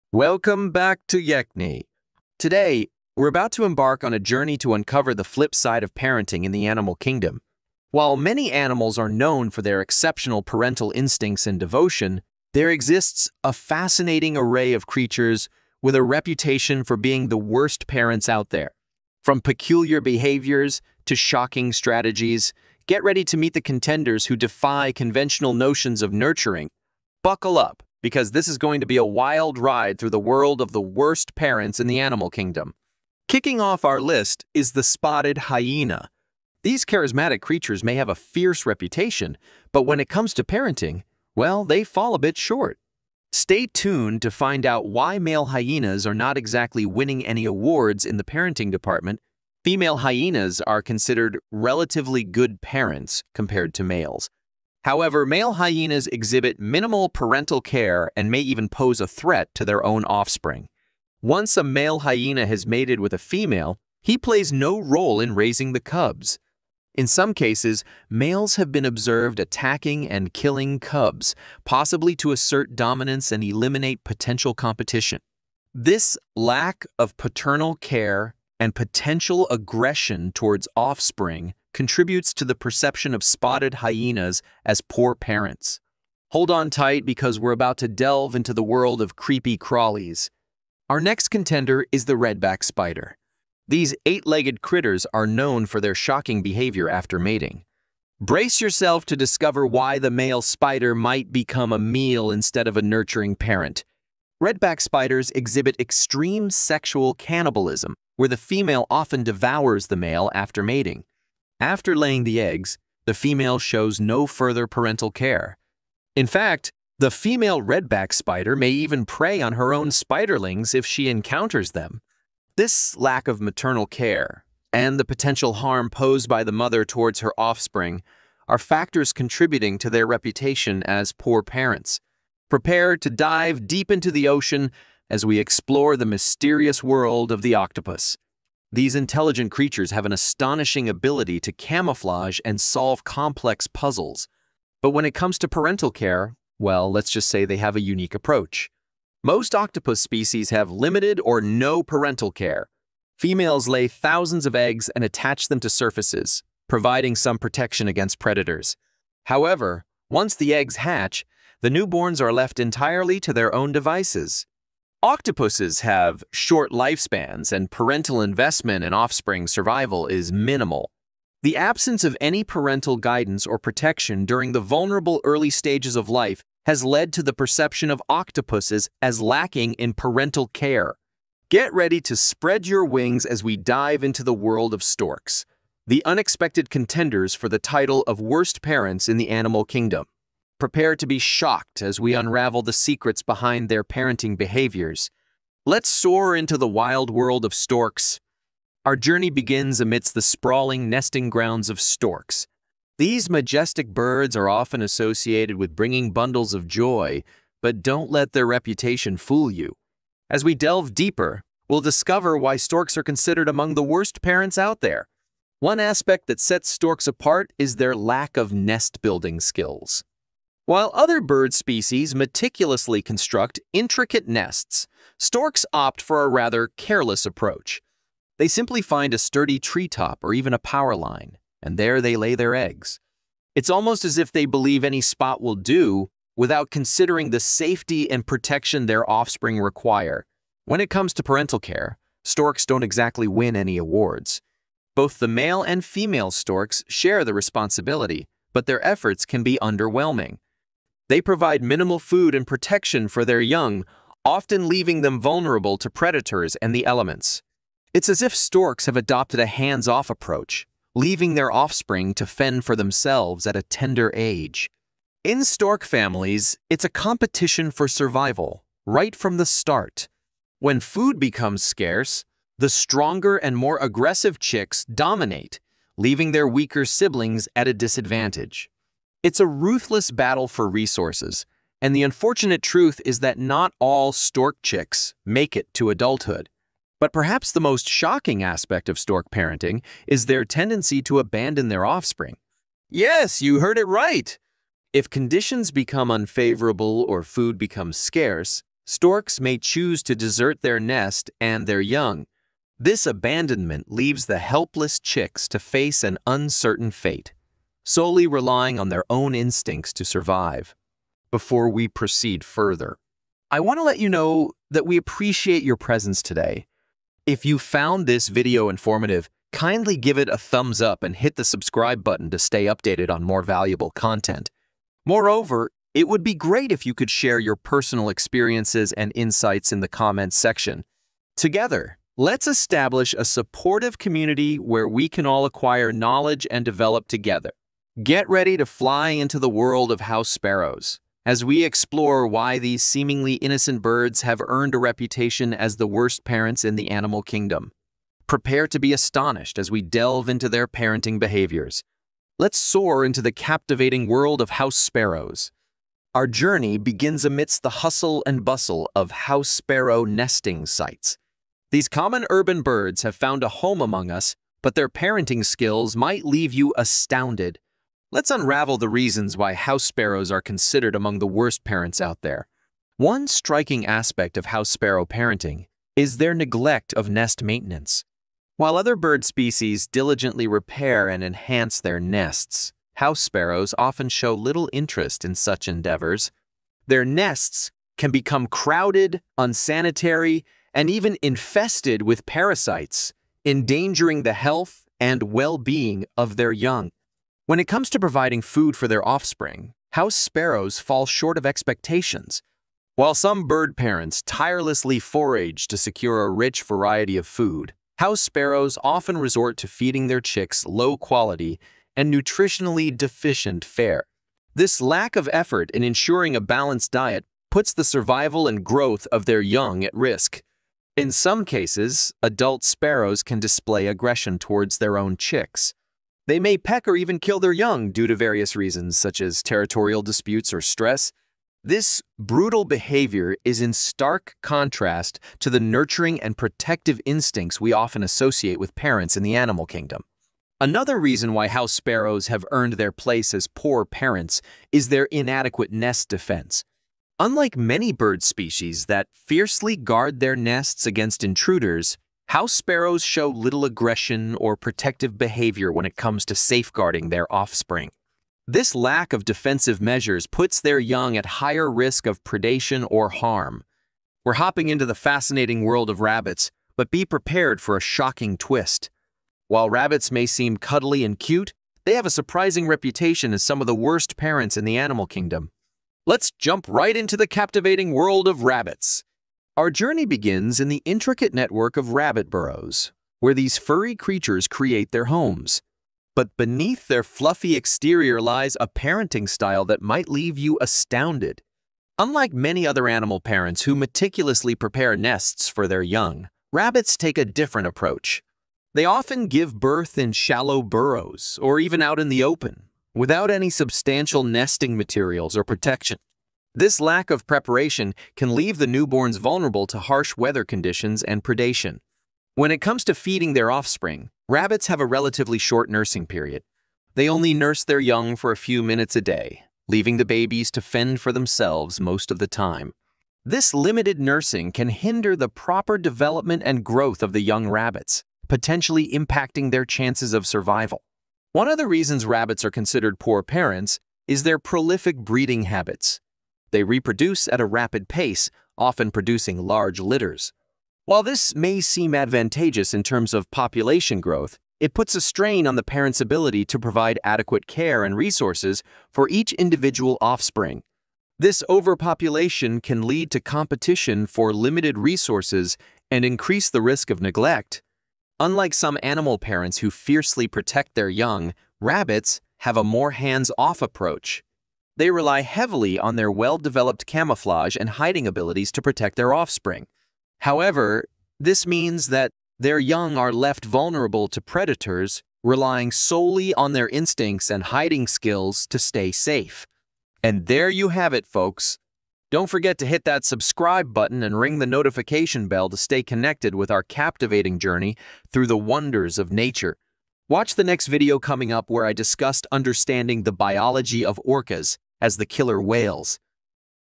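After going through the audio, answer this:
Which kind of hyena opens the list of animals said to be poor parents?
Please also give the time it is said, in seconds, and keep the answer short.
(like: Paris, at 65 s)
spotted hyena, at 34 s.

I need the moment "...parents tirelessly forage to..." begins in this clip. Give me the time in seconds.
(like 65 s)
403 s.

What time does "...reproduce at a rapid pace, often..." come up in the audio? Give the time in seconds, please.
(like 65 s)
536 s.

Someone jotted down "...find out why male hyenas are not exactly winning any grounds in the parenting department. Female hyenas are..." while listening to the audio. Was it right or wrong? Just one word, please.
wrong.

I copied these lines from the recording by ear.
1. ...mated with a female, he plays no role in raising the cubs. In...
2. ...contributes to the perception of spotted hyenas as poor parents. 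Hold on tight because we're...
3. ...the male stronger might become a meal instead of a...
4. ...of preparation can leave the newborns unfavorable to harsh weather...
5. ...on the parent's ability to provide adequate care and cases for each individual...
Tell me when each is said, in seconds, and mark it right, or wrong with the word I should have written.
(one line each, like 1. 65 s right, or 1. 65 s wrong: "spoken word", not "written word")
1. 62 s right
2. 81 s right
3. 99 s wrong: "spider", not "stronger"
4. 507 s wrong: "vulnerable", not "unfavorable"
5. 545 s wrong: "resources", not "cases".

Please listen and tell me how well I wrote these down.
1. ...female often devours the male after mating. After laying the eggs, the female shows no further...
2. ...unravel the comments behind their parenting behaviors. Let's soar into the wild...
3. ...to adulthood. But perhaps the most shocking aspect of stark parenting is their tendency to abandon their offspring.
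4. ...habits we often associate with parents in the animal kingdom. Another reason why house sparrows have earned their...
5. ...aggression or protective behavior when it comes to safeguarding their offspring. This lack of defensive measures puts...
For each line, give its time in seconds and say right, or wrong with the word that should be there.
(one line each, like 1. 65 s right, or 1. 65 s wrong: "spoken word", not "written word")
1. 108 s right
2. 192 s wrong: "secrets", not "comments"
3. 285 s wrong: "stork", not "stark"
4. 437 s wrong: "instincts", not "habits"
5. 453 s right.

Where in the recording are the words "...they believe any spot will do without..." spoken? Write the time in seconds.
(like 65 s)
234 s.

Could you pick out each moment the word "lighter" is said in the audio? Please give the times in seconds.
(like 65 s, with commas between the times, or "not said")
not said.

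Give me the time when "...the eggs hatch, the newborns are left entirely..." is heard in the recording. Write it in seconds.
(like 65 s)
160 s.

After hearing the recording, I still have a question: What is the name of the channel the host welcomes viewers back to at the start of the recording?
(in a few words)
Yekne.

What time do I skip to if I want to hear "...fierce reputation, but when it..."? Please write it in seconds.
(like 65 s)
38 s.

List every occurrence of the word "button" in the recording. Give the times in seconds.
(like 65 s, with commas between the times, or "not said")
322 s, 583 s.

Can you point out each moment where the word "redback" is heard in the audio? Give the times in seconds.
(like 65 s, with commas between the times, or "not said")
92 s, 104 s, 117 s.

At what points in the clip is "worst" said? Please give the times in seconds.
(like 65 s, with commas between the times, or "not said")
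17 s, 30 s, 188 s, 213 s, 345 s, 371 s, 473 s.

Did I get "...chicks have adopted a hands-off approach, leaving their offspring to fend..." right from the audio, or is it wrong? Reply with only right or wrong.
wrong.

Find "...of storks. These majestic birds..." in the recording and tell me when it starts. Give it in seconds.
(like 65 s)
201 s.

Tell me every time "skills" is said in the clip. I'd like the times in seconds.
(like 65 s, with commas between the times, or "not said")
219 s, 365 s, 577 s.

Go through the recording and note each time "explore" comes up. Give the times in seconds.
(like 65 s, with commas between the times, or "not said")
135 s, 341 s.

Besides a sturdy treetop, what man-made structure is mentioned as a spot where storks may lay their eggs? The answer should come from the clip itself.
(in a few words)
power line.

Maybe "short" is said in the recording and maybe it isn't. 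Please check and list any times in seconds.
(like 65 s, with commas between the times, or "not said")
42 s, 166 s, 401 s, 515 s.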